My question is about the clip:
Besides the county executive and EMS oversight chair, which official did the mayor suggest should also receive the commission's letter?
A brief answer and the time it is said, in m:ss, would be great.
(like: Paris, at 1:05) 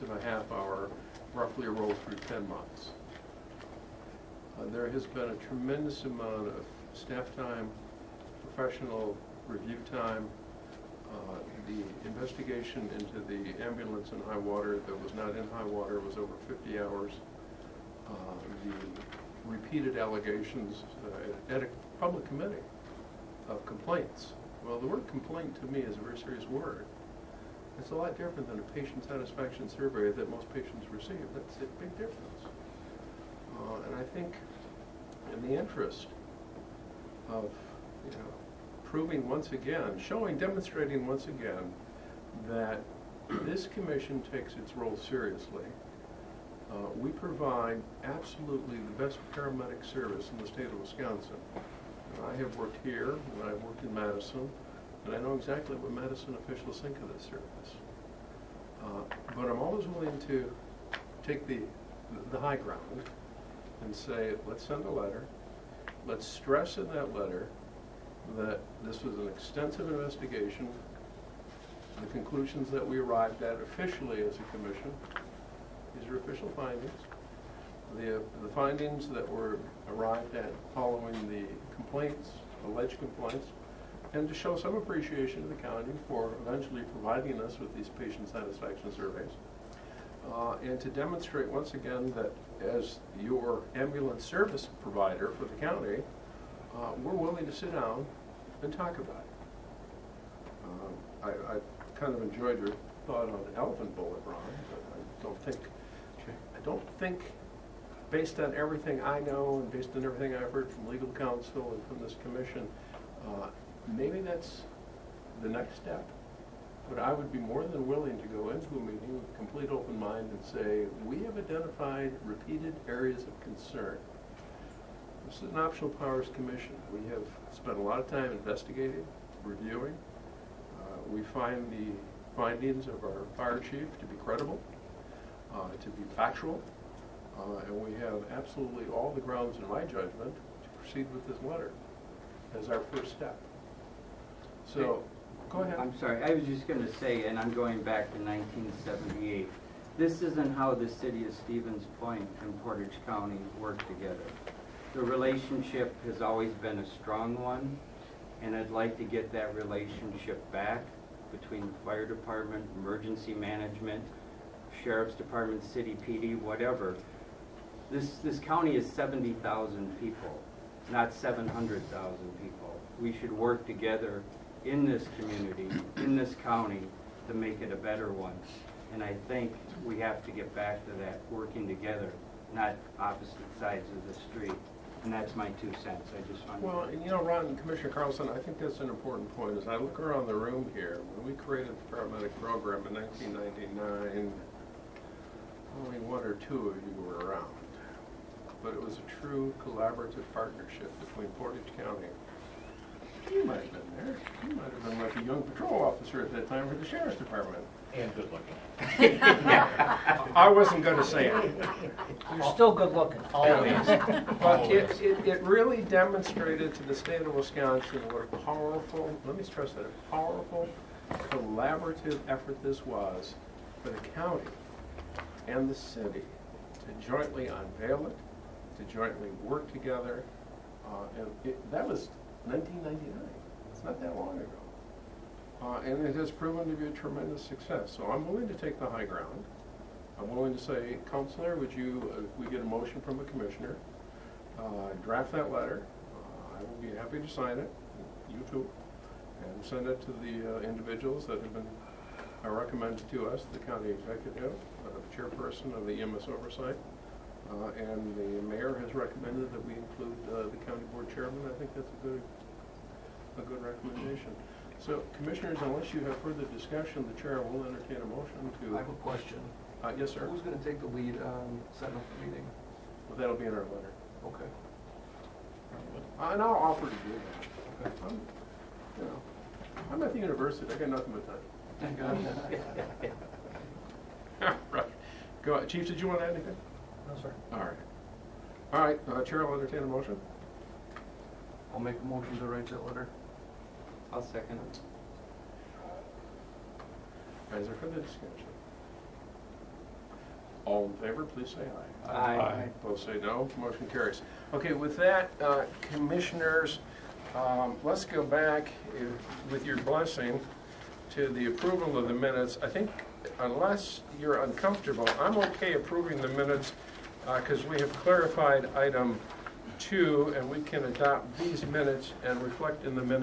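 County board chairman, at 4:20.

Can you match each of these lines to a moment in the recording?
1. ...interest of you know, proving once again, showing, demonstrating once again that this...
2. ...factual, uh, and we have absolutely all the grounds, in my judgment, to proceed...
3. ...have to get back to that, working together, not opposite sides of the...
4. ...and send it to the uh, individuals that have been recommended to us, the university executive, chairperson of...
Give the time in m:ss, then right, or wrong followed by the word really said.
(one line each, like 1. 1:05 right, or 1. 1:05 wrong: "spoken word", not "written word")
1. 0:35 right
2. 2:16 right
3. 2:59 right
4. 4:09 wrong: "county", not "university".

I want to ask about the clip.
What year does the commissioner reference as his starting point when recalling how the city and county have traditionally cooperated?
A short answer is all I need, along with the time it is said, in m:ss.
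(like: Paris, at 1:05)
1978, at 2:28.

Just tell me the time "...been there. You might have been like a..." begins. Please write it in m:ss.
3:23.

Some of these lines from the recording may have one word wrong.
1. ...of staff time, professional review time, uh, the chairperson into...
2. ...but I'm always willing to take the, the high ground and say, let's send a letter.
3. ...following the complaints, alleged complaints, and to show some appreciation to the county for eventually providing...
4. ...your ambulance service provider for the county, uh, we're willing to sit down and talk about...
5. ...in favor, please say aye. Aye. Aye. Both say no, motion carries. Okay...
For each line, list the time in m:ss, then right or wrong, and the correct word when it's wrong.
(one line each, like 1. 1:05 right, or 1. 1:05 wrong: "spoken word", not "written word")
1. 0:06 wrong: "investigation", not "chairperson"
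2. 0:59 right
3. 1:20 right
4. 1:33 right
5. 5:00 right.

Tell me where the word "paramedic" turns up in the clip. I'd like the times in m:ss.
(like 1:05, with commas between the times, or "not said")
0:49, 3:11.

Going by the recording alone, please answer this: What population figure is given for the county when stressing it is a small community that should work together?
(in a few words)
70,000.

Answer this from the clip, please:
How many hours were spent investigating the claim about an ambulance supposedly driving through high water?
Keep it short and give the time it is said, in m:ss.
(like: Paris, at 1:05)
Over 50 hours, at 0:16.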